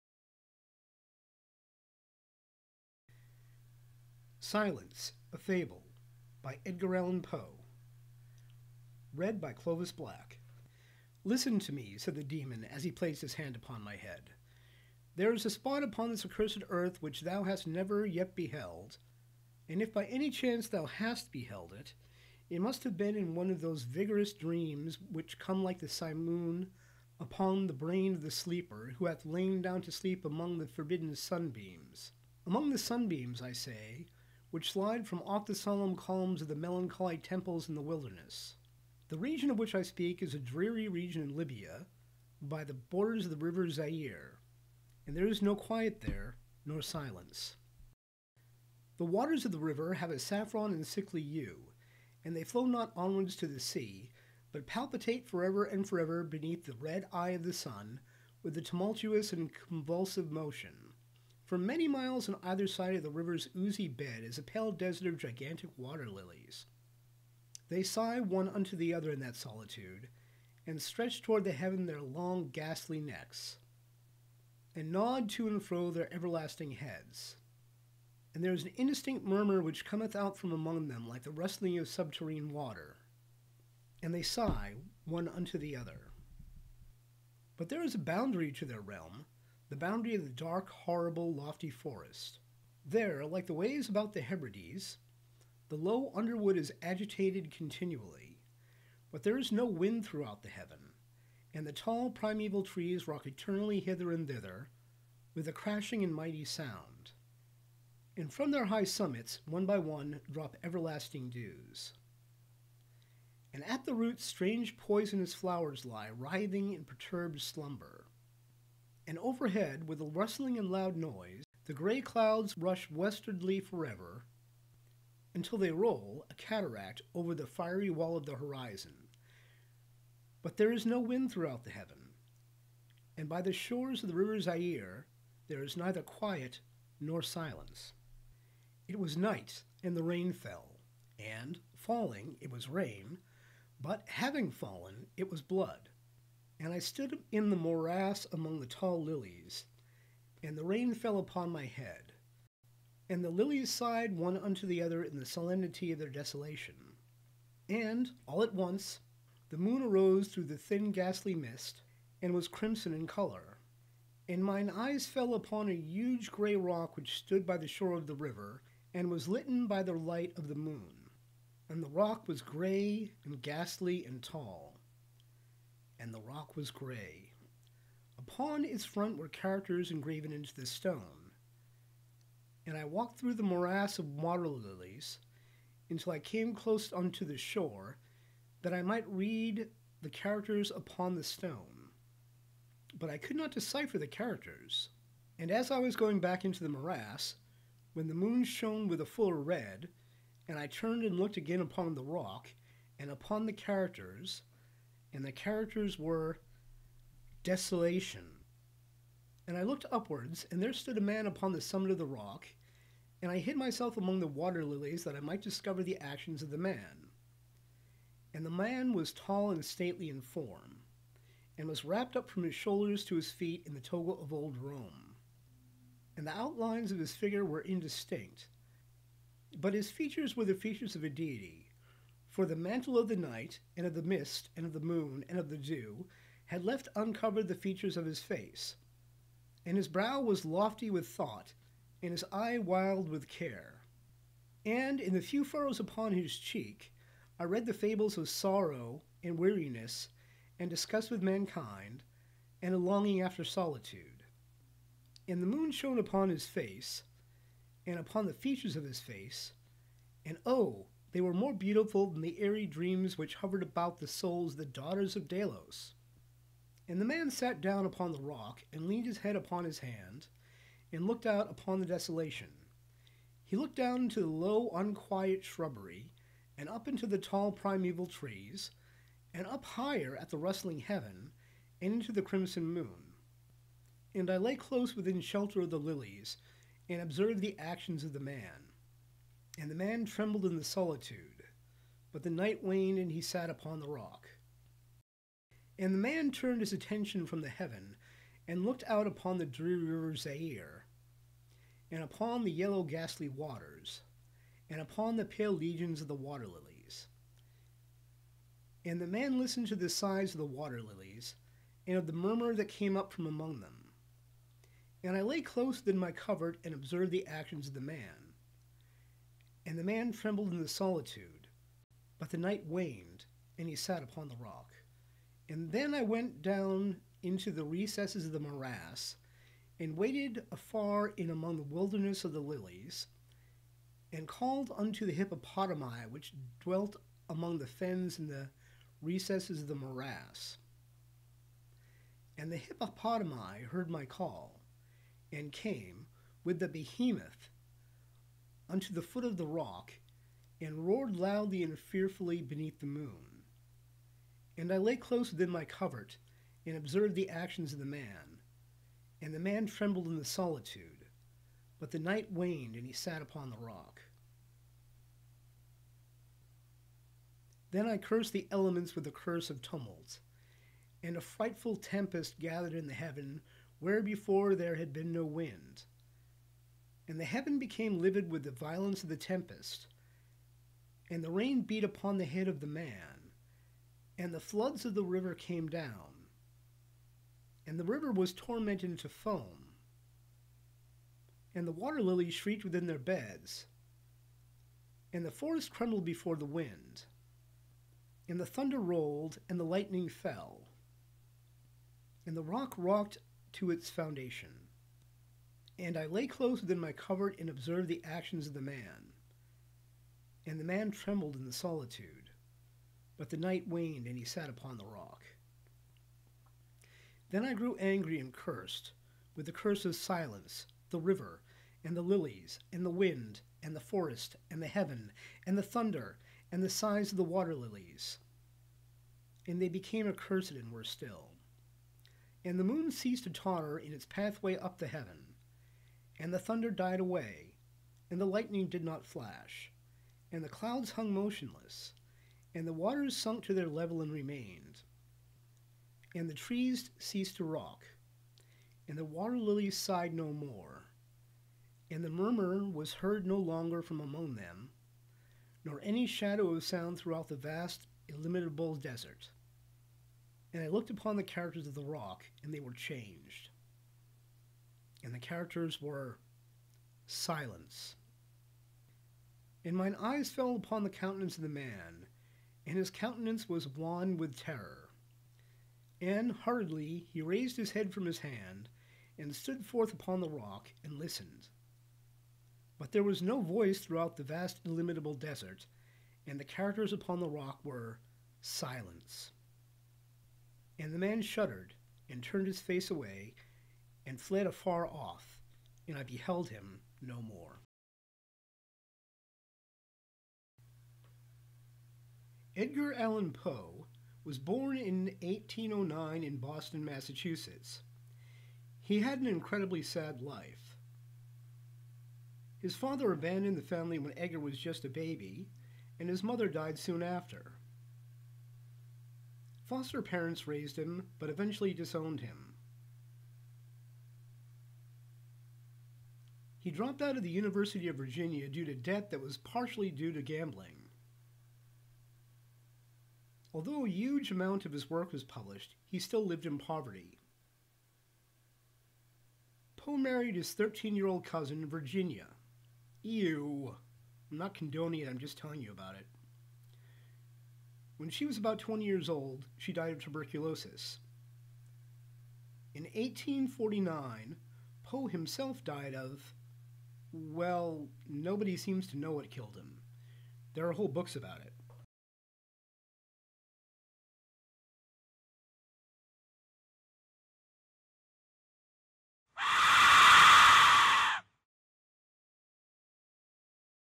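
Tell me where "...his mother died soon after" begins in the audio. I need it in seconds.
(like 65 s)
516 s.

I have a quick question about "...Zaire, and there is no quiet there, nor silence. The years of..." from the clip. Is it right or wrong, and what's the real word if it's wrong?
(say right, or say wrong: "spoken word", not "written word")
wrong: "waters", not "years".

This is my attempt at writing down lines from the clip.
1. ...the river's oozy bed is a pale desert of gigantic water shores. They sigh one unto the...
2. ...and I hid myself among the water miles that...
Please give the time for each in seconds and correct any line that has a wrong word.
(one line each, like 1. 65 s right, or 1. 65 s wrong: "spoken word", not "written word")
1. 63 s wrong: "lilies", not "shores"
2. 213 s wrong: "lilies", not "miles".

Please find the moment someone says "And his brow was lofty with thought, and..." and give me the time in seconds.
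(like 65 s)
239 s.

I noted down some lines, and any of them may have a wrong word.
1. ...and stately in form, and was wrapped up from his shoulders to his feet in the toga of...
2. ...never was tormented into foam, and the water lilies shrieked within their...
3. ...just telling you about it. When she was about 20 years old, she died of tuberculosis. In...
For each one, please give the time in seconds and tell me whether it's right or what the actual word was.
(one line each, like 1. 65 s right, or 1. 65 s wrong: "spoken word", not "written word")
1. 219 s right
2. 387 s wrong: "river", not "never"
3. 545 s right.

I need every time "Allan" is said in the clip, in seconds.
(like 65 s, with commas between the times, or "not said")
6 s, 502 s.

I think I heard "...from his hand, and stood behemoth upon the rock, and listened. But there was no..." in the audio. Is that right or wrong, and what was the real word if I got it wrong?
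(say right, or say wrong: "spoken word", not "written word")
wrong: "forth", not "behemoth".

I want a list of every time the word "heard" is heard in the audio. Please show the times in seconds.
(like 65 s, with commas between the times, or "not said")
343 s, 452 s.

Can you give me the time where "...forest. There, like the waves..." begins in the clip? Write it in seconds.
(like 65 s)
91 s.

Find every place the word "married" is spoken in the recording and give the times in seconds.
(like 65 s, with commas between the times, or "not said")
539 s.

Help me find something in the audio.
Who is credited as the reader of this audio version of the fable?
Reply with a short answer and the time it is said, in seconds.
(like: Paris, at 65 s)
Clovis Black, at 9 s.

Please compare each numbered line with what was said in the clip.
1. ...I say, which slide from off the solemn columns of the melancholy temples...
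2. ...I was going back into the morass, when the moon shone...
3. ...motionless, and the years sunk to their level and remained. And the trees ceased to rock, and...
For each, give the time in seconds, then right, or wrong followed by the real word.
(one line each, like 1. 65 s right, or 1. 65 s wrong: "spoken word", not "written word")
1. 33 s right
2. 195 s right
3. 441 s wrong: "waters", not "years".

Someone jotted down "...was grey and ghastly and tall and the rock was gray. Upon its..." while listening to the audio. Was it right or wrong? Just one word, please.
right.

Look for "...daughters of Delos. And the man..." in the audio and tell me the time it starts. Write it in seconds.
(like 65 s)
264 s.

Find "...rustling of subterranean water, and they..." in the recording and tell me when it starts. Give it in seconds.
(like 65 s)
81 s.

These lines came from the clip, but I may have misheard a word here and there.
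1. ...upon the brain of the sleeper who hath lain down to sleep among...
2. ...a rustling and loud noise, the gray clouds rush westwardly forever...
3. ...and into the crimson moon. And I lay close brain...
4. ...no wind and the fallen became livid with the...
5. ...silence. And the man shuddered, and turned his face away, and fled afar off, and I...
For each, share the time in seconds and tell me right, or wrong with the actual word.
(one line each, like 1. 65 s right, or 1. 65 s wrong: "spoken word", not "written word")
1. 27 s right
2. 120 s right
3. 281 s wrong: "within", not "brain"
4. 375 s wrong: "heaven", not "fallen"
5. 488 s right.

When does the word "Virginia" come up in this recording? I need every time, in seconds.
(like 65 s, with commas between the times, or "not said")
527 s, 541 s.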